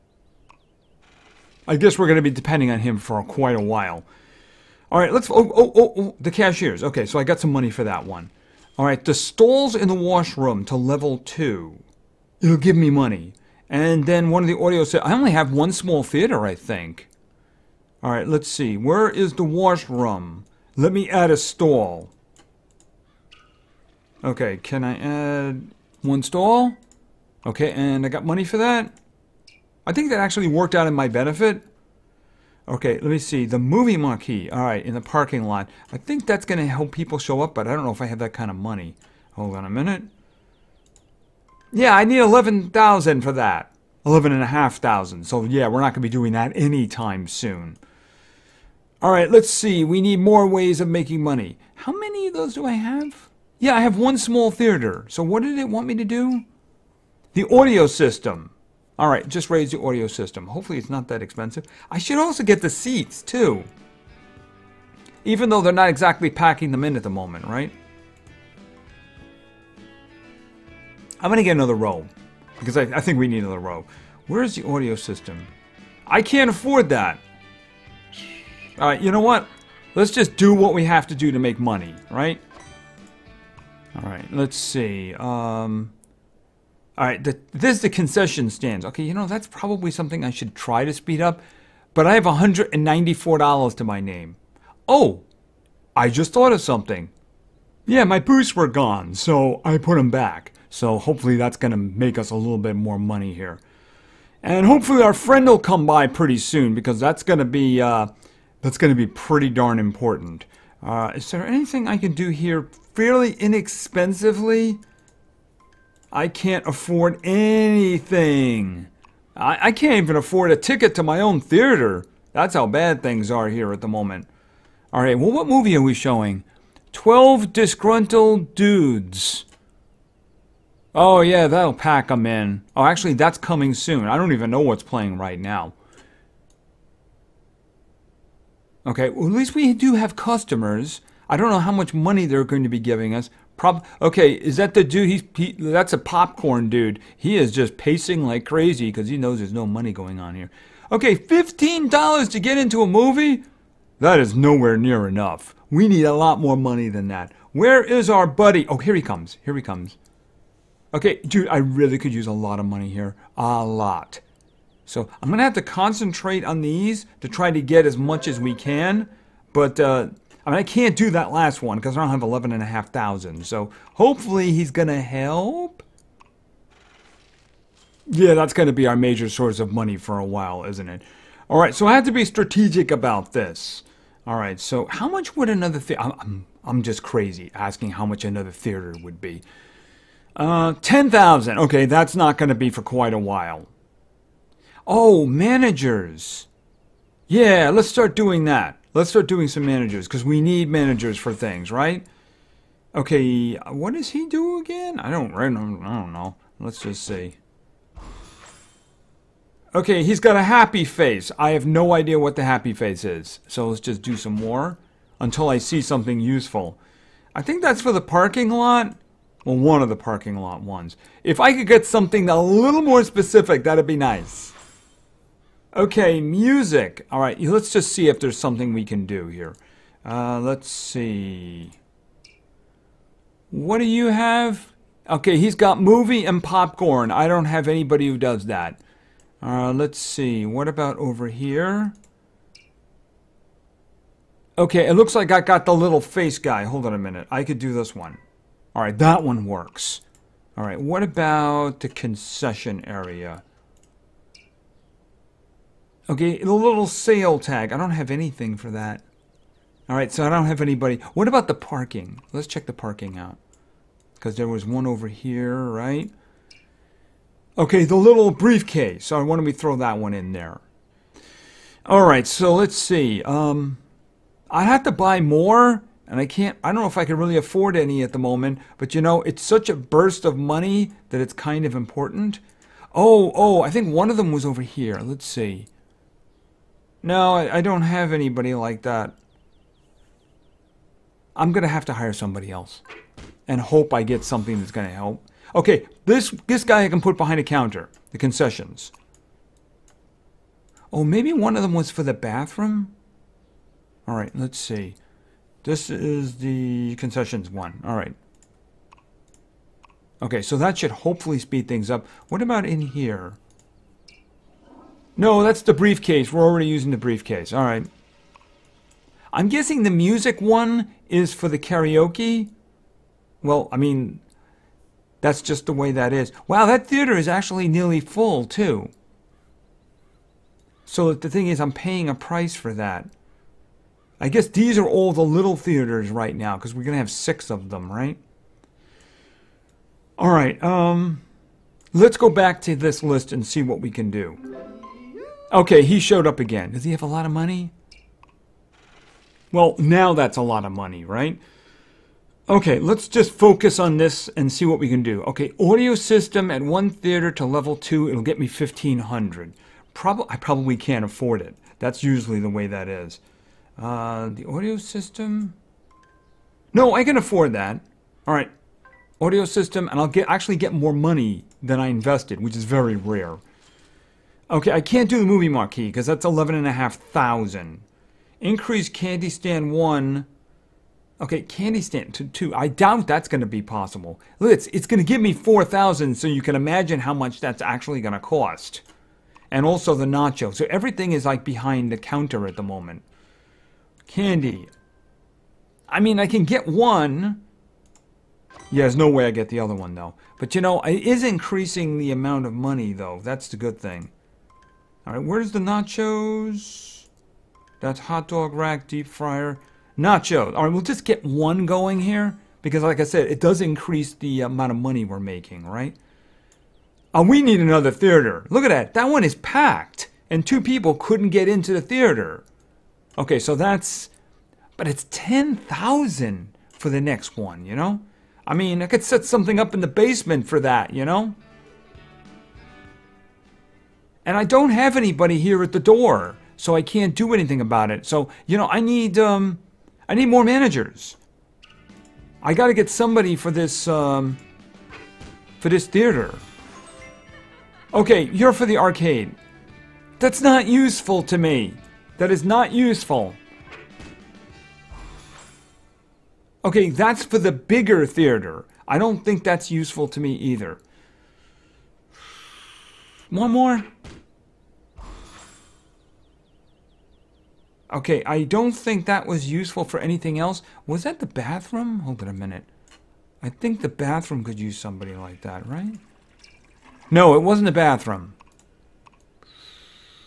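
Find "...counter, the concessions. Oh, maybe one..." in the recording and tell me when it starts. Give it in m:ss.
4:57.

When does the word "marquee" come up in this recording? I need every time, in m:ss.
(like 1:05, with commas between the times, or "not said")
0:33, 6:15.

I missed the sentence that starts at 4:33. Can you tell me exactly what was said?
Um, I'd have to buy more, and I can't.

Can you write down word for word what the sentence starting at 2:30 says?
Okay, fifteen dollars to get into a movie.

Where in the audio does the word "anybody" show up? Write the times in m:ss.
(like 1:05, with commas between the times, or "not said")
3:57, 4:20, 4:48, 7:14.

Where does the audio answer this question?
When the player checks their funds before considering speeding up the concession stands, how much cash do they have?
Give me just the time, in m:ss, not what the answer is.
1:32.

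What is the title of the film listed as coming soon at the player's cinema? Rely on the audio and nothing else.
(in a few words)
12 Disgruntled Dudes.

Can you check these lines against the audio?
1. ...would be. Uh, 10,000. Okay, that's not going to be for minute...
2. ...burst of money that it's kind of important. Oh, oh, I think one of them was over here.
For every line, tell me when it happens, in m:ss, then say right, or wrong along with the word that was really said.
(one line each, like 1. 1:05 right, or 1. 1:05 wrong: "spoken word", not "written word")
1. 3:09 wrong: "quite", not "minute"
2. 4:39 right.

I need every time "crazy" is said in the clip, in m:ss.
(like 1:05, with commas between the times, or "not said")
2:28, 3:07.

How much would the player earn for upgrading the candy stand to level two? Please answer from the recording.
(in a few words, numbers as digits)
4,000.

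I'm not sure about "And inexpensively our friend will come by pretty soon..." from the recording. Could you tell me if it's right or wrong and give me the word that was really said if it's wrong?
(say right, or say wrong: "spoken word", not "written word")
wrong: "hopefully", not "inexpensively".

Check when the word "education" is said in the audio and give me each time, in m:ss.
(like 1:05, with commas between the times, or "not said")
not said.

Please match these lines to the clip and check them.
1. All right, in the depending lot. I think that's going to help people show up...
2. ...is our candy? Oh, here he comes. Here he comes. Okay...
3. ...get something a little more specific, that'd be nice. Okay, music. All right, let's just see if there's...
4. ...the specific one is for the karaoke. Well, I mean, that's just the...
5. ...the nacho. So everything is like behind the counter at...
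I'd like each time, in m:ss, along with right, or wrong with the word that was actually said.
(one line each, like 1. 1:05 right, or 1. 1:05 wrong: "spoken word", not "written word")
1. 0:34 wrong: "parking", not "depending"
2. 2:37 wrong: "buddy", not "candy"
3. 3:41 right
4. 5:19 wrong: "music", not "specific"
5. 6:29 right.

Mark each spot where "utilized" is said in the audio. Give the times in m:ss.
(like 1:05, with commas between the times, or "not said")
not said.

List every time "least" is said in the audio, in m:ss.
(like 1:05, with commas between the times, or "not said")
2:19.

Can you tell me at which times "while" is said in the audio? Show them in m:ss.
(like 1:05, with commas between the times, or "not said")
0:03, 3:00, 3:13.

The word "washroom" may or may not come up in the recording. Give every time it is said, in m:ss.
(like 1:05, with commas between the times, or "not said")
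0:09, 0:19.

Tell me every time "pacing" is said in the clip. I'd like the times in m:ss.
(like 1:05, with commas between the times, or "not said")
2:27.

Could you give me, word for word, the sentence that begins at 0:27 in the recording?
Okay, and I got money for that.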